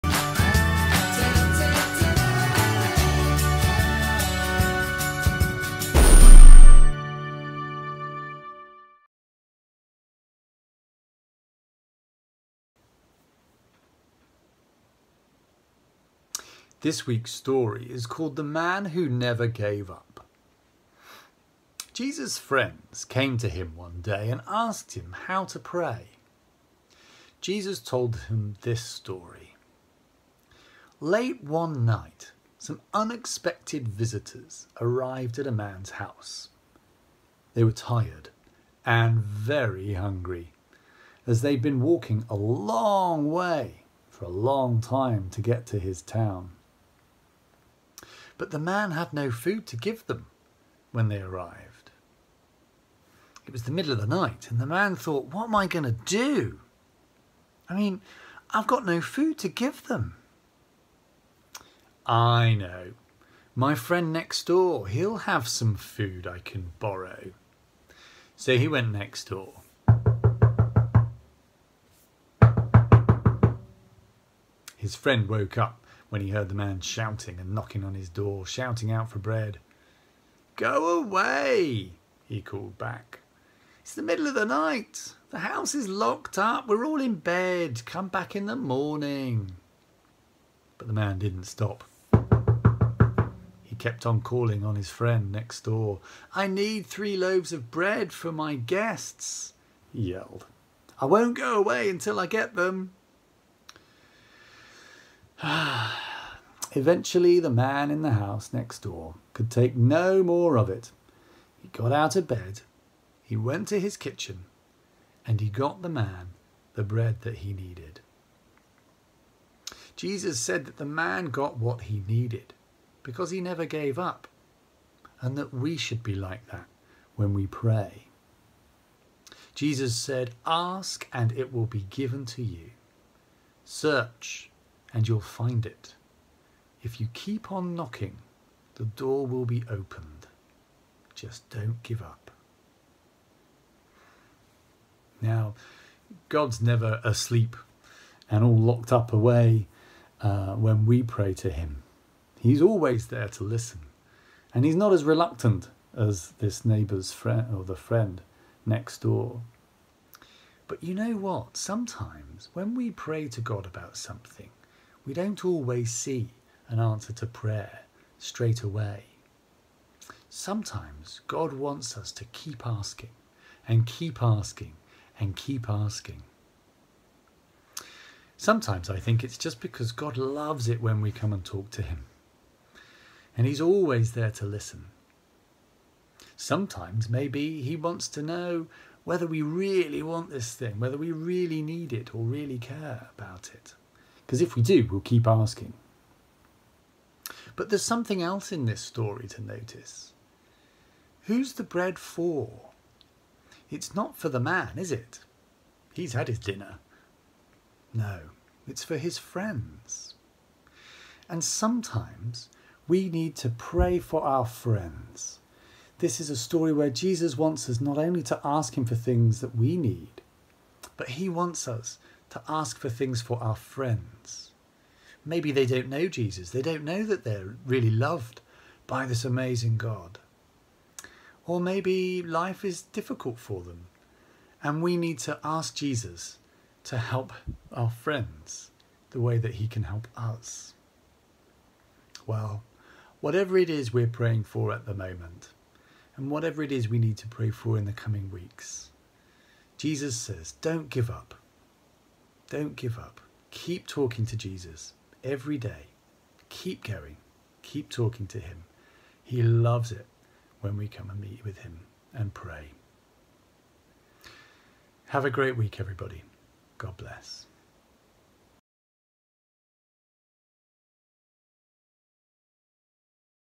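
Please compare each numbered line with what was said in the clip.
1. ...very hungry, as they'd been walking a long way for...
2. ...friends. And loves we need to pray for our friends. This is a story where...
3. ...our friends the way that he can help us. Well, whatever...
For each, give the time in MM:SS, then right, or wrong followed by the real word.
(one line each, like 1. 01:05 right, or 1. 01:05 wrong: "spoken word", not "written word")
1. 00:39 right
2. 03:29 wrong: "sometimes", not "loves"
3. 03:57 right.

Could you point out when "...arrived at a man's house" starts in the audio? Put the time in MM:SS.
00:34.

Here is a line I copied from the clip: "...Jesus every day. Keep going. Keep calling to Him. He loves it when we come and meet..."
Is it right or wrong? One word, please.
wrong.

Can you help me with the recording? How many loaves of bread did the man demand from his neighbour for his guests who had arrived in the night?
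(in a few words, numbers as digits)
3.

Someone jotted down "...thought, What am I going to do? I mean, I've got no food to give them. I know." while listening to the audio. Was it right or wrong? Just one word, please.
right.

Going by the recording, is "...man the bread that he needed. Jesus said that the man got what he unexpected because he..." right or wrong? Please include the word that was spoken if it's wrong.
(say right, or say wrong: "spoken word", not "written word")
wrong: "needed", not "unexpected".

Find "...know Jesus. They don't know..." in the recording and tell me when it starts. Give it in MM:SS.
03:45.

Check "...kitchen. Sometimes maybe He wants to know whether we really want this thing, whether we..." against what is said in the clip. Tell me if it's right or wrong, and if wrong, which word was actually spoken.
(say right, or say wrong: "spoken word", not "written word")
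wrong: "listen", not "kitchen".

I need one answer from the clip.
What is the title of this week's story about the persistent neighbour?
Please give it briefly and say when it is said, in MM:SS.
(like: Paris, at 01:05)
The Man Who Never Gave Up, at 00:18.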